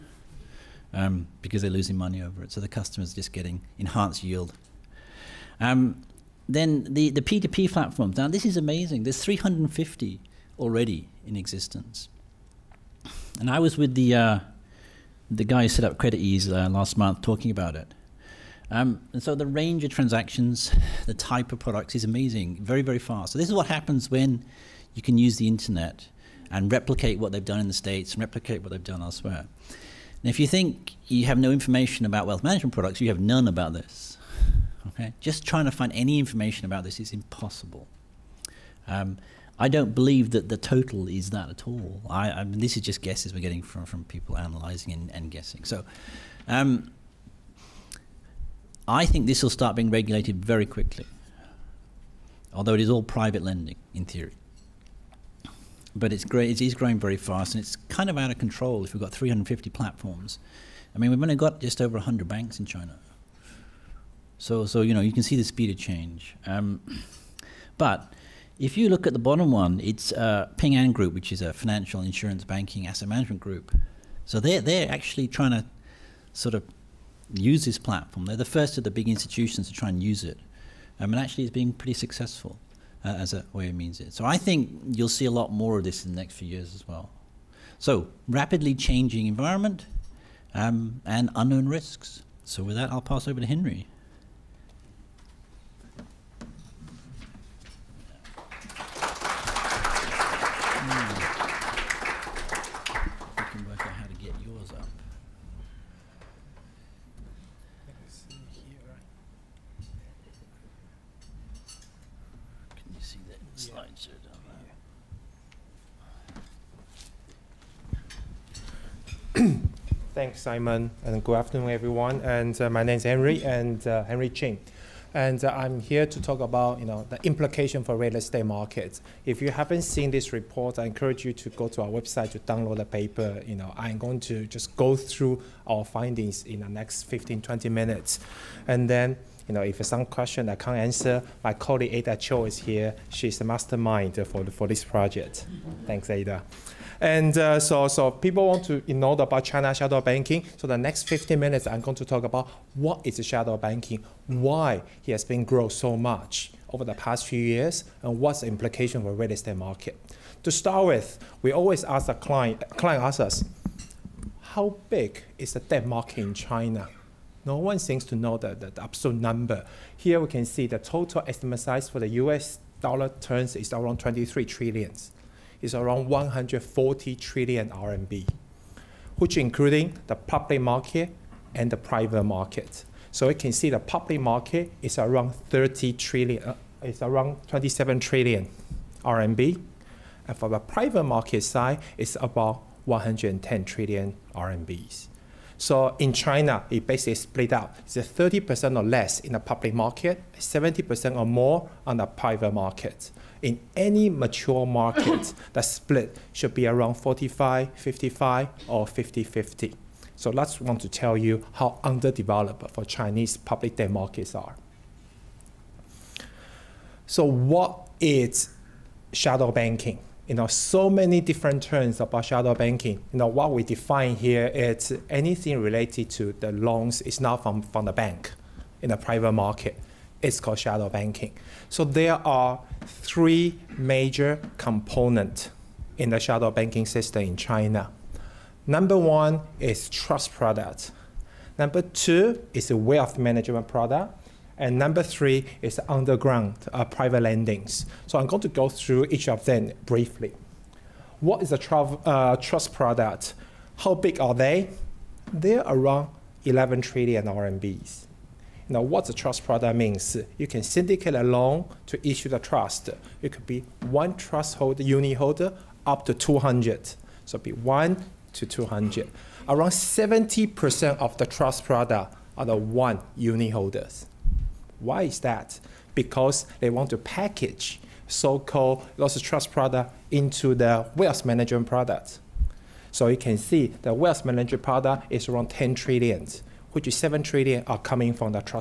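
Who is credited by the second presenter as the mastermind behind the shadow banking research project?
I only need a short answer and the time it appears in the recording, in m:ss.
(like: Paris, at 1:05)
Ada Cho, at 2:21.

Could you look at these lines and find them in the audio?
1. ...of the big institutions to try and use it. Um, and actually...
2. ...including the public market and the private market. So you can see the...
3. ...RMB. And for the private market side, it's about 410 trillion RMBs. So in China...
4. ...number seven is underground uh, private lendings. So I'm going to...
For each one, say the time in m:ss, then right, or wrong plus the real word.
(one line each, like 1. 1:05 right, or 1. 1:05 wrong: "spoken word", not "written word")
1. 1:18 right
2. 2:59 right
3. 3:09 wrong: "110", not "410"
4. 4:04 wrong: "three", not "seven".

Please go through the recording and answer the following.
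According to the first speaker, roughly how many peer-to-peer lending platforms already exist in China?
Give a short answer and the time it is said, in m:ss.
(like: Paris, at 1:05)
350, at 0:09.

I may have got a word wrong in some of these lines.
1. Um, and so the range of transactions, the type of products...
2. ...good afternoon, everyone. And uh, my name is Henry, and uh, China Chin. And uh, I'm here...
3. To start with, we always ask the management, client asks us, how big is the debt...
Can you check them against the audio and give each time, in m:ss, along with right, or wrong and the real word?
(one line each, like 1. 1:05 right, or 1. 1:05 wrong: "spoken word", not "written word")
1. 0:18 right
2. 2:01 wrong: "Henry", not "China"
3. 2:40 wrong: "client", not "management".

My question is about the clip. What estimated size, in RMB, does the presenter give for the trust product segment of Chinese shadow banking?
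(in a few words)
11 trillion RMB.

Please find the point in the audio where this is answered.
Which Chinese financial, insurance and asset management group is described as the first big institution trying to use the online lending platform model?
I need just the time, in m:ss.
1:10.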